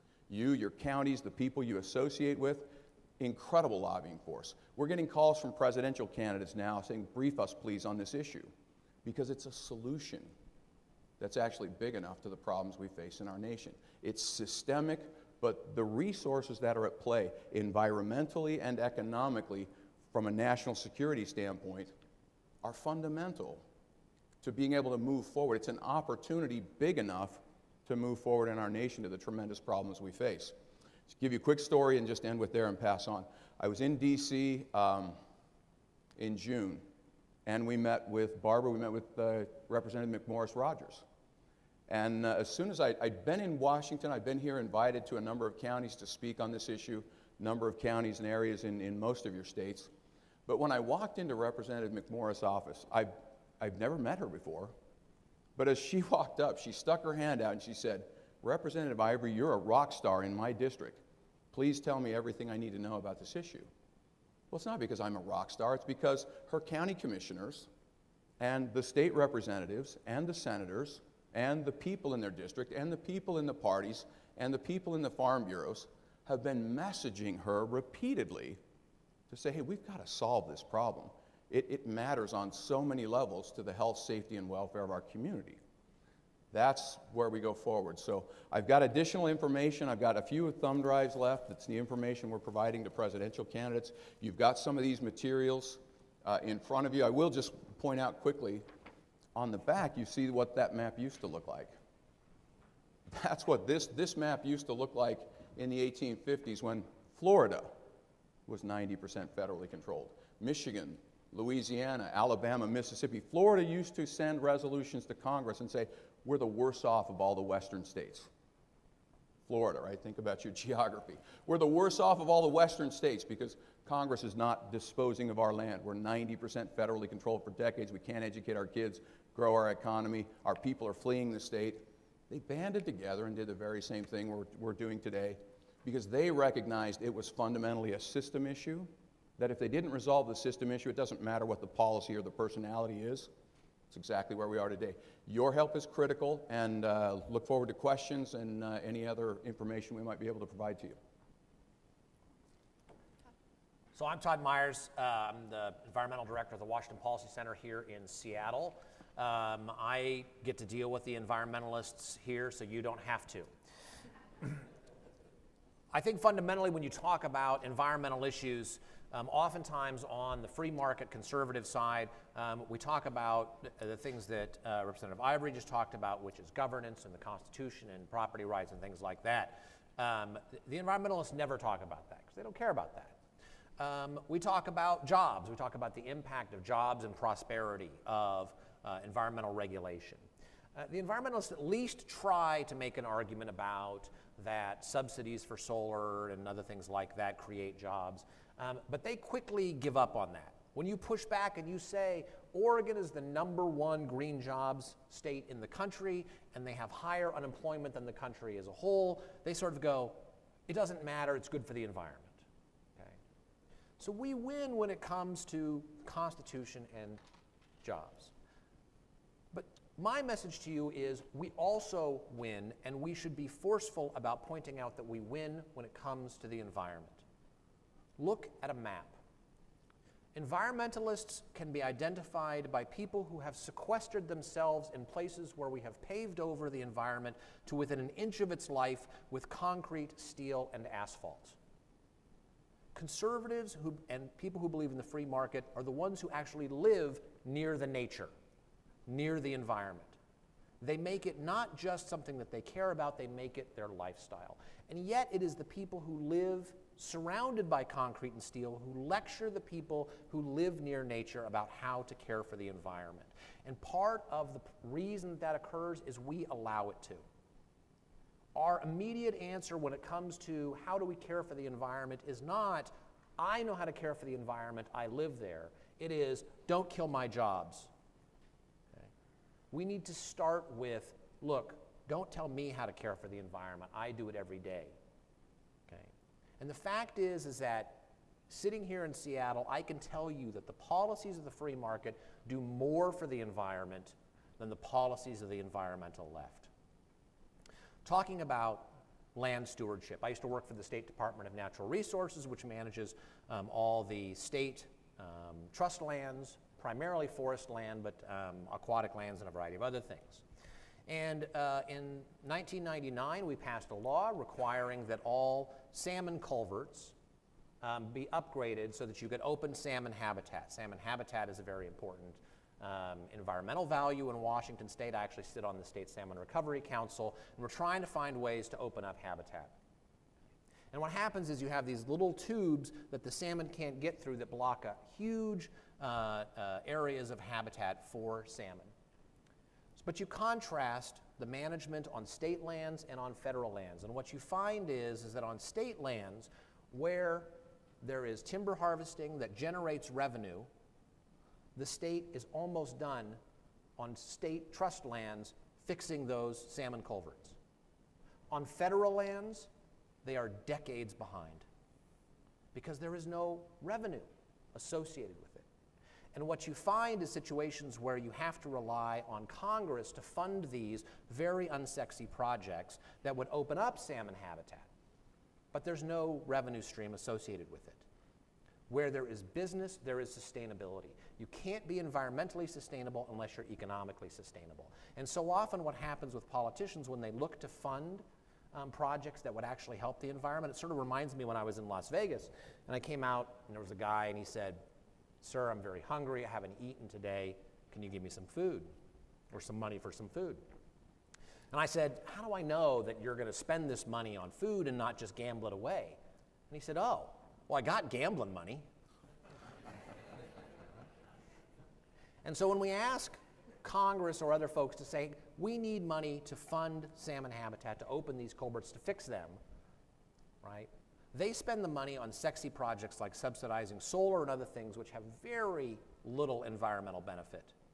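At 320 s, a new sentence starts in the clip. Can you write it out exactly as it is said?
Salmon habitat is a very important um, environmental value in Washington state.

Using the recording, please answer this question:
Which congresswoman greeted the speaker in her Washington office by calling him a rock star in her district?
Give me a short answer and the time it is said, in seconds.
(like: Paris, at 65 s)
McMorris Rodgers, at 40 s.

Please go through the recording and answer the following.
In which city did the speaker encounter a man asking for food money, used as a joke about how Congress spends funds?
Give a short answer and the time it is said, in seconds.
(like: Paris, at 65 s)
Las Vegas, at 391 s.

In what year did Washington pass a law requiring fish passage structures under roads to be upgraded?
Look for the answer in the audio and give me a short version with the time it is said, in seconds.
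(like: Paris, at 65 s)
1999, at 312 s.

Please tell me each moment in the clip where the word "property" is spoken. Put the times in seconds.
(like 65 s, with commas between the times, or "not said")
178 s.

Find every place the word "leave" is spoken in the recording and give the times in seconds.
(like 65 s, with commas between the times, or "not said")
not said.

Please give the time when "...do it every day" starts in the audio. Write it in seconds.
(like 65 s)
284 s.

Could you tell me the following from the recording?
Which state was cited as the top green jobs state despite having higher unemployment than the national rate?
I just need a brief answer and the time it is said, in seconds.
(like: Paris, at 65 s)
Oregon, at 202 s.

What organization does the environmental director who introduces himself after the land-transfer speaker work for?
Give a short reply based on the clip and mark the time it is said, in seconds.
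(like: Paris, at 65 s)
Washington Policy Center, at 156 s.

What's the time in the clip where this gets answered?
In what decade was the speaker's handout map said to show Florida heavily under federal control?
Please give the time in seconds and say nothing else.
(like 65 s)
105 s.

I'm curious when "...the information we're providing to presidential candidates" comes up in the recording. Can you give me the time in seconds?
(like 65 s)
91 s.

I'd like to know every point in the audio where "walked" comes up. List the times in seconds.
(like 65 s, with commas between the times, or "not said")
50 s, 56 s.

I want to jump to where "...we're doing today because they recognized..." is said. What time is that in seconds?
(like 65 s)
134 s.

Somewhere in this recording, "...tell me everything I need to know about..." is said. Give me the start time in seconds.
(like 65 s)
61 s.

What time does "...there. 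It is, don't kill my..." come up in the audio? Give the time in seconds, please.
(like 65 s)
275 s.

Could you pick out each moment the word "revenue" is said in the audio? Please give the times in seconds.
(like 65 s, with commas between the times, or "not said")
350 s, 363 s, 376 s.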